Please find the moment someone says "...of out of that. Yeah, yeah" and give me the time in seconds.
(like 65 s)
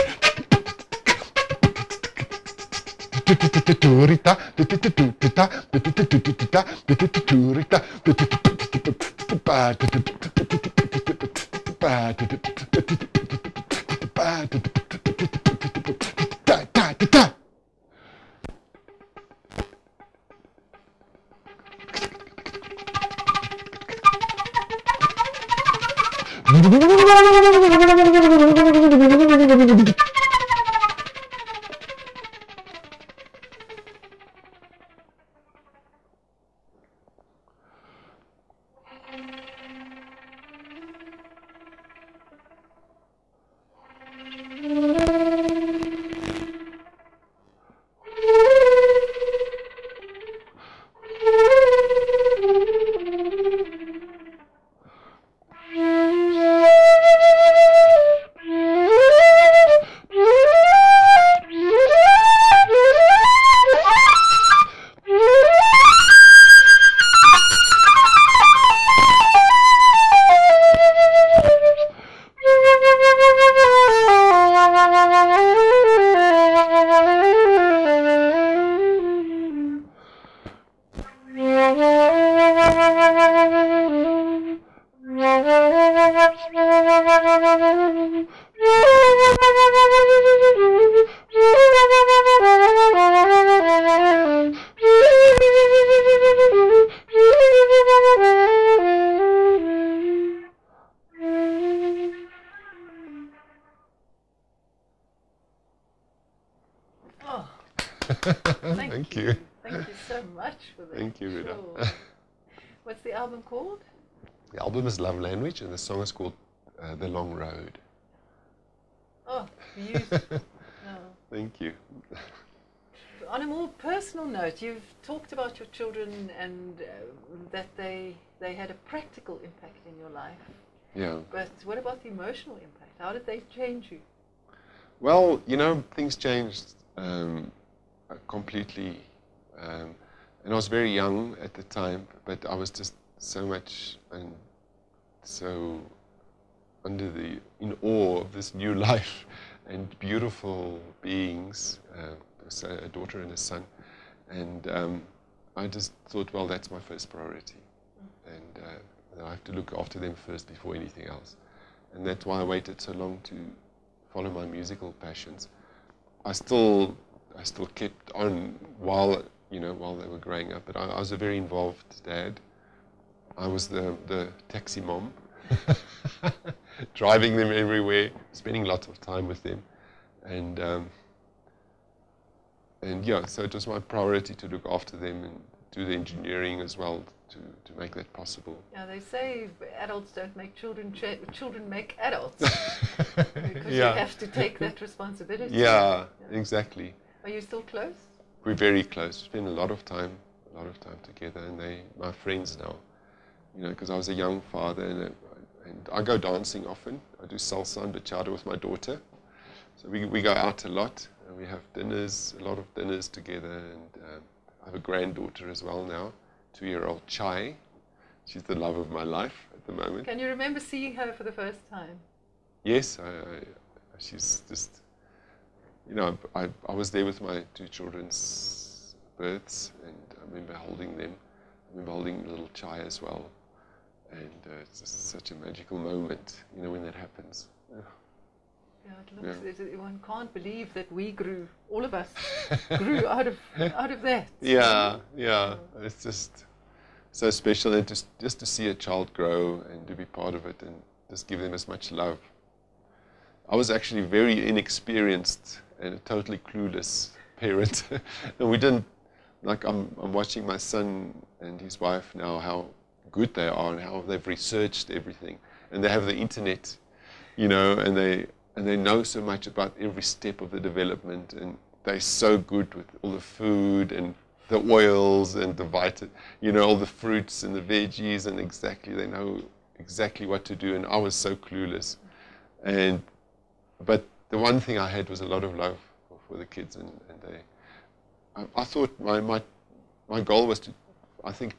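243 s.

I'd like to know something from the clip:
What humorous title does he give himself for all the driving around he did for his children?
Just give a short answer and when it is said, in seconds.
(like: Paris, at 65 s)
Taxi mom, at 174 s.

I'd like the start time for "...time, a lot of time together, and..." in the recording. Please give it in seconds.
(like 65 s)
199 s.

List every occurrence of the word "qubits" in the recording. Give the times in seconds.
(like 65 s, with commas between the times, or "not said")
not said.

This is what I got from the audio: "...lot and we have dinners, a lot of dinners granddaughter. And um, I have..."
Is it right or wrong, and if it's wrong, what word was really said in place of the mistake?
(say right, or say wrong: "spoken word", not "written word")
wrong: "together", not "granddaughter".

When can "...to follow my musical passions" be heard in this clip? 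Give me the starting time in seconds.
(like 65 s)
163 s.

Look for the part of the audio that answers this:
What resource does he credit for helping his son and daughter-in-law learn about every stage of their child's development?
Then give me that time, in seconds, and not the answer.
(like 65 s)
266 s.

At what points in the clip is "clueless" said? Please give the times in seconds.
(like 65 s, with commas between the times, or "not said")
256 s, 281 s.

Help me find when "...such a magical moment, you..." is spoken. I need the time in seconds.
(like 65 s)
234 s.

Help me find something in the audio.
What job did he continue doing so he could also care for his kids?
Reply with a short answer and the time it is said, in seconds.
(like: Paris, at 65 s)
Engineering, at 185 s.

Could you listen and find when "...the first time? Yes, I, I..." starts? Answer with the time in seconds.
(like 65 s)
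221 s.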